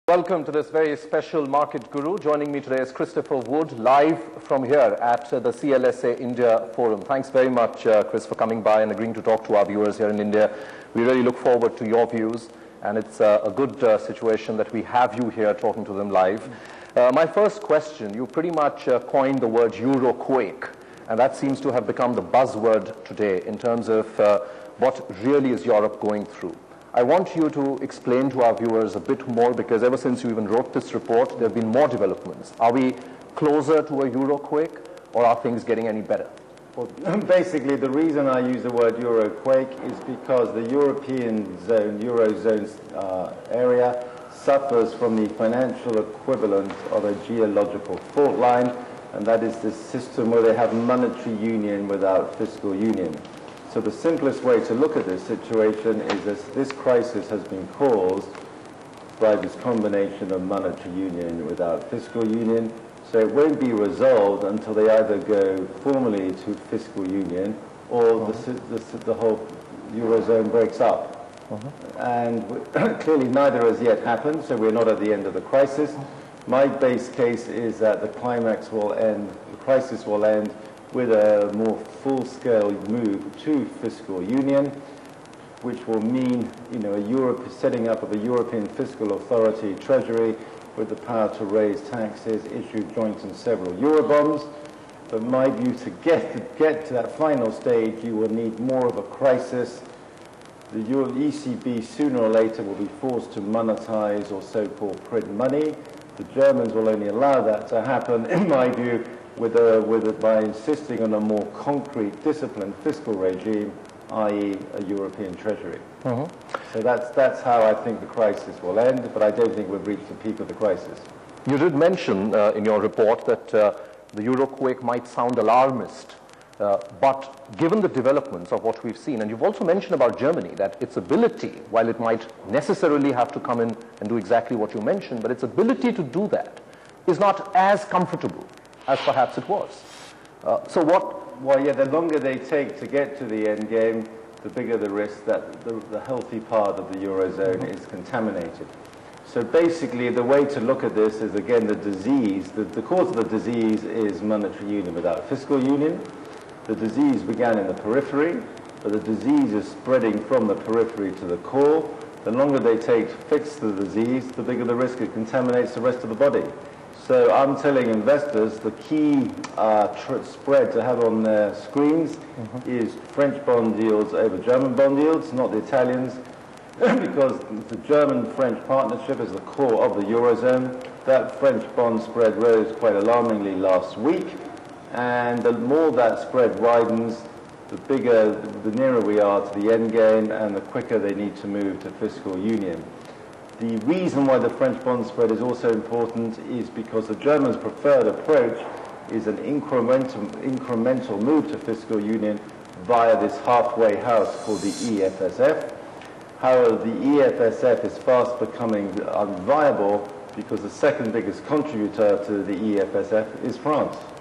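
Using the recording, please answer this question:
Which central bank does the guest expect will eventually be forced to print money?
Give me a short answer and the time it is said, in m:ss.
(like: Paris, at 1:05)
ECB, at 1:41.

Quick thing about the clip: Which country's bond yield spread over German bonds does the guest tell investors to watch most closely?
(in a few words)
France.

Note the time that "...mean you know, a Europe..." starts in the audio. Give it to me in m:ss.
1:26.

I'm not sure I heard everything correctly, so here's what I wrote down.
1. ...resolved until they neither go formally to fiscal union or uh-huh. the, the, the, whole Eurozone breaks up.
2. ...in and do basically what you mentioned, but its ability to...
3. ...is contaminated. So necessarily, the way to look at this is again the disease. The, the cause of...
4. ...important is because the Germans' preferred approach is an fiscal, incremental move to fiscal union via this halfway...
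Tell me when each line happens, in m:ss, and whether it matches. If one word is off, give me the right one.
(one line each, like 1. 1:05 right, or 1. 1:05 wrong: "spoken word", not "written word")
1. 1:03 wrong: "either", not "neither"
2. 2:13 wrong: "exactly", not "basically"
3. 2:27 wrong: "basically", not "necessarily"
4. 3:15 wrong: "incremental", not "fiscal".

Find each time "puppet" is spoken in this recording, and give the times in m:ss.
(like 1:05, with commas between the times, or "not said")
not said.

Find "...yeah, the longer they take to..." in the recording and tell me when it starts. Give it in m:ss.
2:21.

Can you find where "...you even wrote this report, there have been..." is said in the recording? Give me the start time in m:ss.
0:30.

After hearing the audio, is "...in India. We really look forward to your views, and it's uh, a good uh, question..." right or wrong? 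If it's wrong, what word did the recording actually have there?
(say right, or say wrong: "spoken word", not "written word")
wrong: "situation", not "question".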